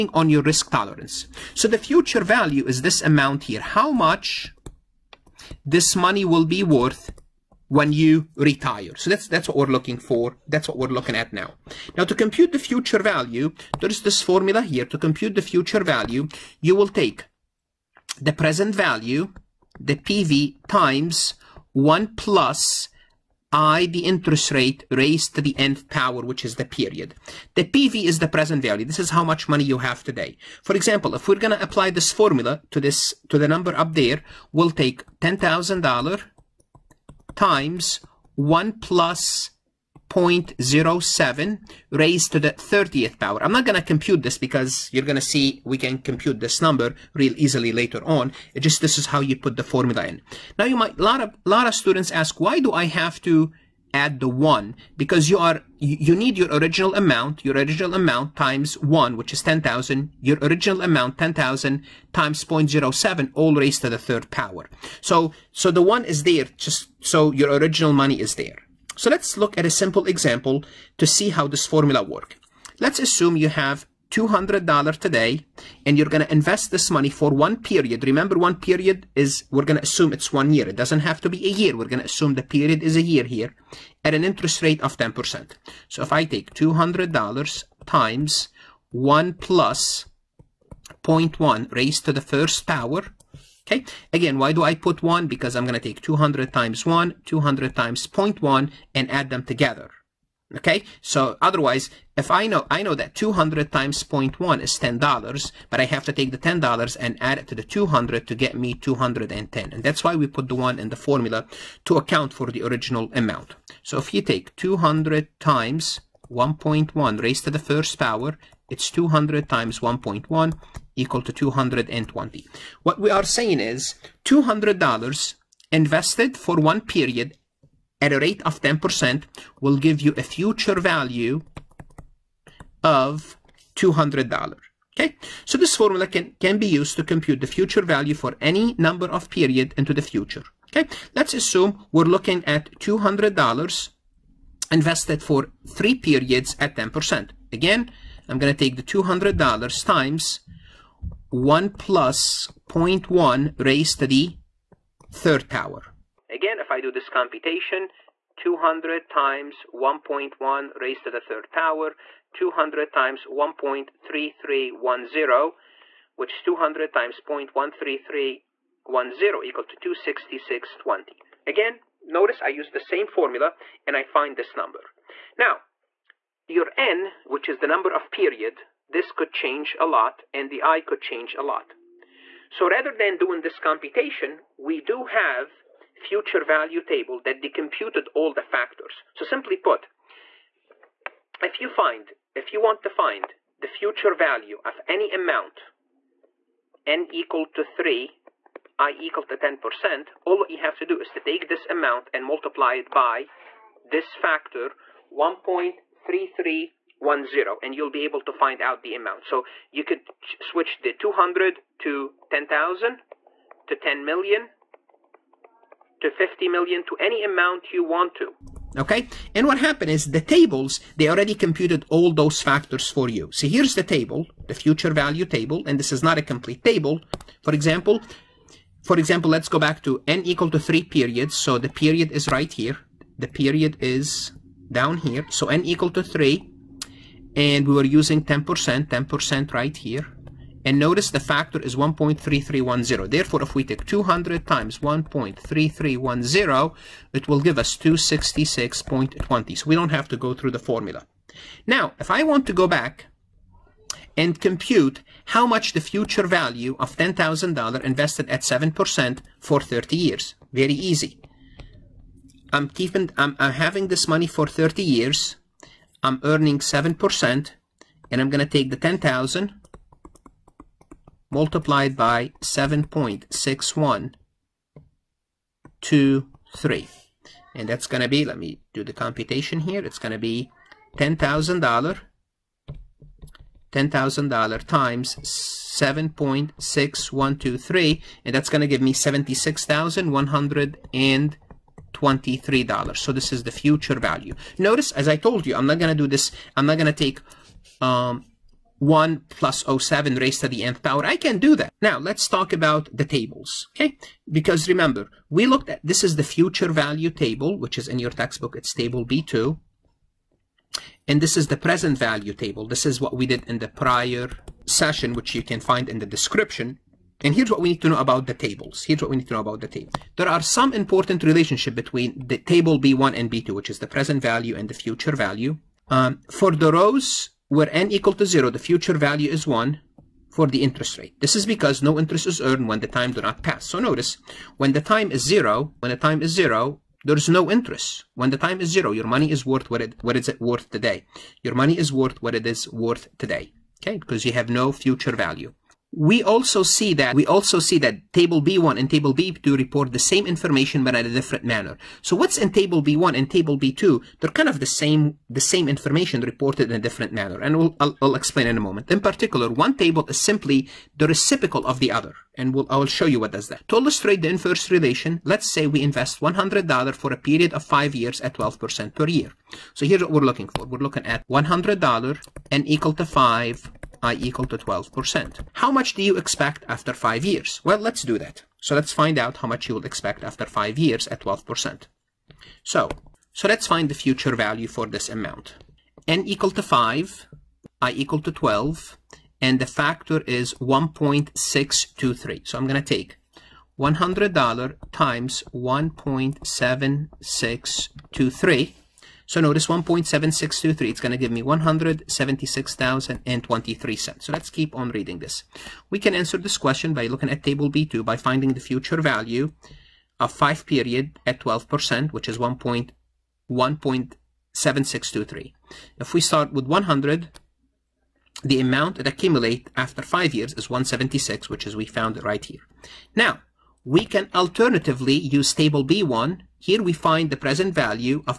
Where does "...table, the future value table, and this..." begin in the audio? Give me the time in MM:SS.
03:43.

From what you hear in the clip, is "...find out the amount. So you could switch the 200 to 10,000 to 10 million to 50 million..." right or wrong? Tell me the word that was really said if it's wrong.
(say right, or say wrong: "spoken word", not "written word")
right.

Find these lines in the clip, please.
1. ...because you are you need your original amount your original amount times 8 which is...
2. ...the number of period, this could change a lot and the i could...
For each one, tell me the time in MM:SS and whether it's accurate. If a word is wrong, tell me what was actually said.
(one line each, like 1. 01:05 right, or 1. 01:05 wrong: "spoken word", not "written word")
1. 00:54 wrong: "1", not "8"
2. 02:57 right.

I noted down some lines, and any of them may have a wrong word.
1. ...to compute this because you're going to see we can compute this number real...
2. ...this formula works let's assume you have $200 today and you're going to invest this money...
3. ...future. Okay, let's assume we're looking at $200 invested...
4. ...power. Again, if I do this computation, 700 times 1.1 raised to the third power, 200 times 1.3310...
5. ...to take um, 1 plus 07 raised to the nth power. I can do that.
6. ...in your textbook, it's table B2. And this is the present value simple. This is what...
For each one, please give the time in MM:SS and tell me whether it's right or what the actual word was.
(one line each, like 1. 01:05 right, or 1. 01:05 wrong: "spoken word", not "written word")
1. 00:43 right
2. 01:11 right
3. 02:20 right
4. 02:35 wrong: "200", not "700"
5. 04:56 right
6. 05:07 wrong: "table", not "simple".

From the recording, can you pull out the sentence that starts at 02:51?
Again, notice I use the same formula and I find this number.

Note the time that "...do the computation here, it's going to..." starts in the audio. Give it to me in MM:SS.
04:38.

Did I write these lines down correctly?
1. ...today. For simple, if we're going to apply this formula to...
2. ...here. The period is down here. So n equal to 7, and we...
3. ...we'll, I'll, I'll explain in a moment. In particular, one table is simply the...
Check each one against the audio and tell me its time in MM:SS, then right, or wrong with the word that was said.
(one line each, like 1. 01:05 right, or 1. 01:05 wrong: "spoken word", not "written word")
1. 00:30 wrong: "example", not "simple"
2. 03:52 wrong: "3", not "7"
3. 05:57 right.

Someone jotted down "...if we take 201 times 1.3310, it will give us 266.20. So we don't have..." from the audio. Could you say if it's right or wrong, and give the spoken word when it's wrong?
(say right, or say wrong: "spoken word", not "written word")
wrong: "200", not "201".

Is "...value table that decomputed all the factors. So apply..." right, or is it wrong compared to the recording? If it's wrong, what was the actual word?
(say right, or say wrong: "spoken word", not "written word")
wrong: "simply", not "apply".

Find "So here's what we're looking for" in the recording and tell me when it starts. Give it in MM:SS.
06:09.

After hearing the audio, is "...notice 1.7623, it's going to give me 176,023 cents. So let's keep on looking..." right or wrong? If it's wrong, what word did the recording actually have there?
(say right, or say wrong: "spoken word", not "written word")
wrong: "reading", not "looking".